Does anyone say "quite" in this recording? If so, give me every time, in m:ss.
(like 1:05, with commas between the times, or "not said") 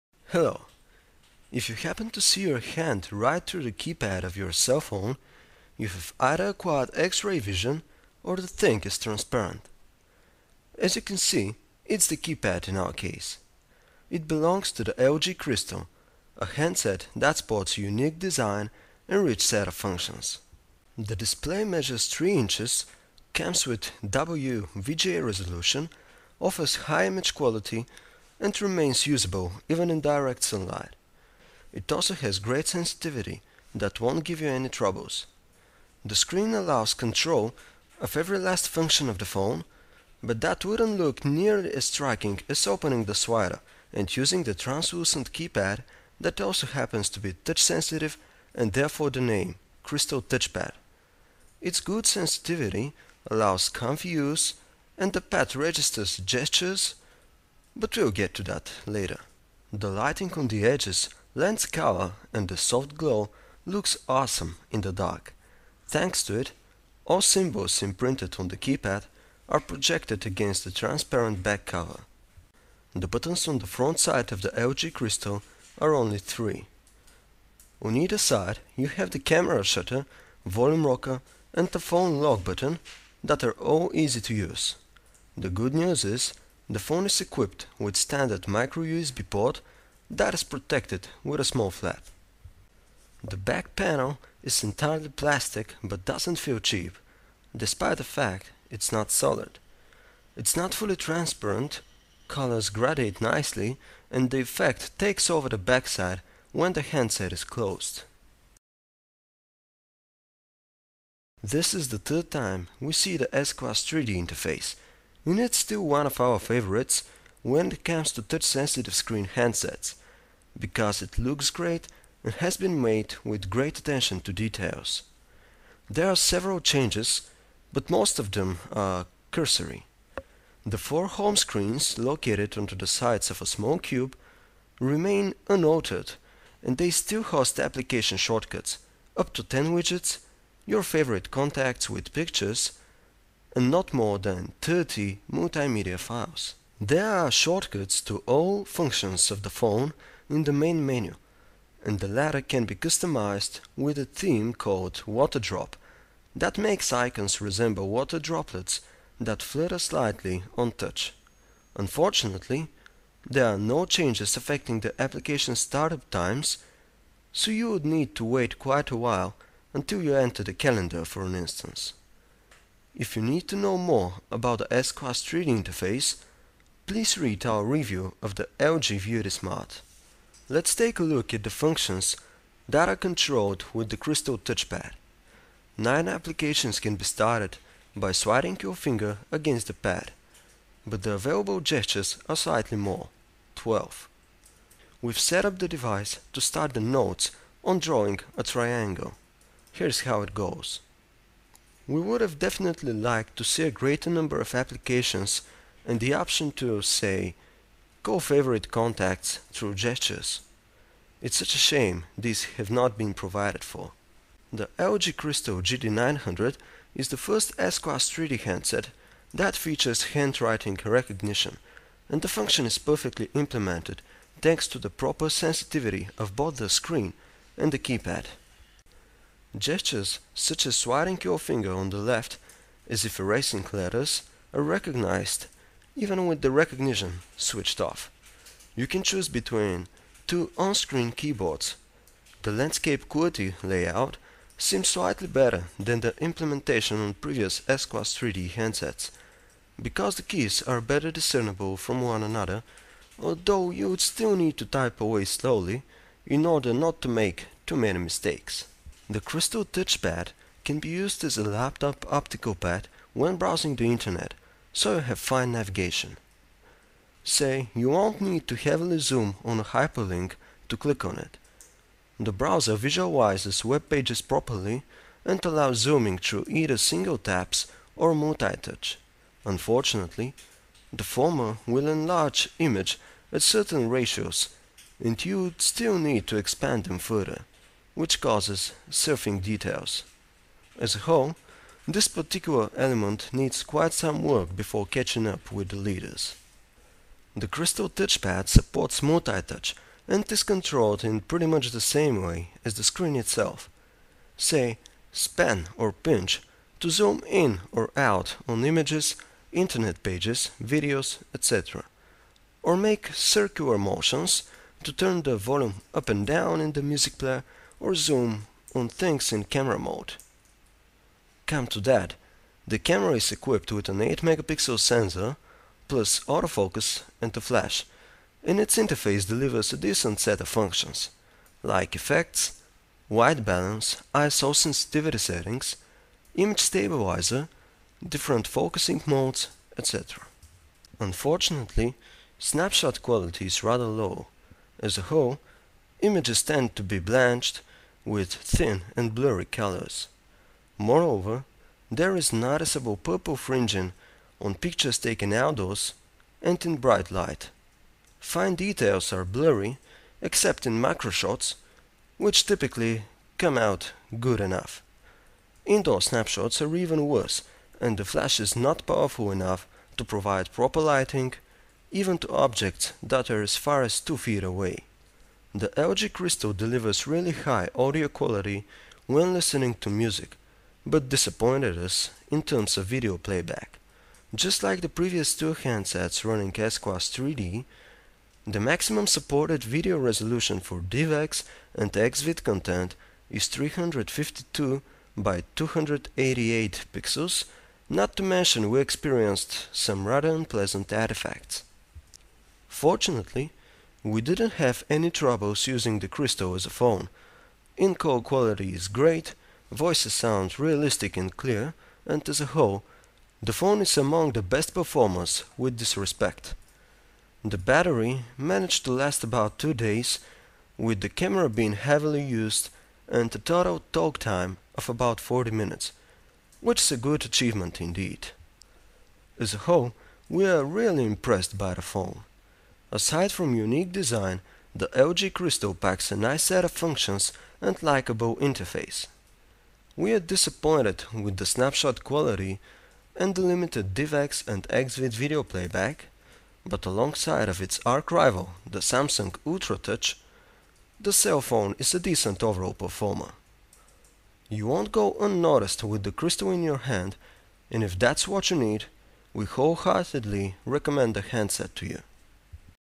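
2:48, 4:53.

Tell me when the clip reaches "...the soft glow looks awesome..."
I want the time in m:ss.
1:02.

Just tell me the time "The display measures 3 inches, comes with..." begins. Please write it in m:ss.
0:20.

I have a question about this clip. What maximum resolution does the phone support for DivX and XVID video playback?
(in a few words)
352 by 288 pixels.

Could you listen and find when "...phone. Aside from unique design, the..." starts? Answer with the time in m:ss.
7:11.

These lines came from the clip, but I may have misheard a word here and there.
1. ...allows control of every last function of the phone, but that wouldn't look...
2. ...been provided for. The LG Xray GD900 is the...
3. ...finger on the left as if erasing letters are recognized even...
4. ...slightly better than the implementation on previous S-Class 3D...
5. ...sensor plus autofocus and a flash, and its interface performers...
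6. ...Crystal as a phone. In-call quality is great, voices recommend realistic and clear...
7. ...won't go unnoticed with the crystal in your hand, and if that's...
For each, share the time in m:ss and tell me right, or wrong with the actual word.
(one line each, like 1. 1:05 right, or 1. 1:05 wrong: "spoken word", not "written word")
1. 0:36 right
2. 3:32 wrong: "Crystal", not "Xray"
3. 3:51 right
4. 4:04 right
5. 5:24 wrong: "delivers", not "performers"
6. 6:46 wrong: "sound", not "recommend"
7. 7:34 right.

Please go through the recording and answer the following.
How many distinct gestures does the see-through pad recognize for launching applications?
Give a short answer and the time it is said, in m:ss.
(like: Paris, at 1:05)
12, at 3:13.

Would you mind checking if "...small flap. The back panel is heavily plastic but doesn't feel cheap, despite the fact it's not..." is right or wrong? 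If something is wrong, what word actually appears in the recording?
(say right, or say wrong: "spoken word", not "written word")
wrong: "entirely", not "heavily".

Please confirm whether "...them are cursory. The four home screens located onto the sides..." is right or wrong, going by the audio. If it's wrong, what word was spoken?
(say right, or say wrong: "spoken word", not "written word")
right.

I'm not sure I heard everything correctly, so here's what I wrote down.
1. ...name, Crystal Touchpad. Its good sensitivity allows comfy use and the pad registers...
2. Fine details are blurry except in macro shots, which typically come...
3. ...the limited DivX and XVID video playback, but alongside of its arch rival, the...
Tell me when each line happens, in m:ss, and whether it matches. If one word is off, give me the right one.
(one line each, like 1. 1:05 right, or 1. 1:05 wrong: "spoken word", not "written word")
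1. 0:49 right
2. 5:58 right
3. 7:23 right.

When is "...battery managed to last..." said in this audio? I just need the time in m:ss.
6:57.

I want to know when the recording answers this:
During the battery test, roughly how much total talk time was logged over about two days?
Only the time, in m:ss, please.
7:05.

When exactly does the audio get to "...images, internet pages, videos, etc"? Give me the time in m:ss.
5:08.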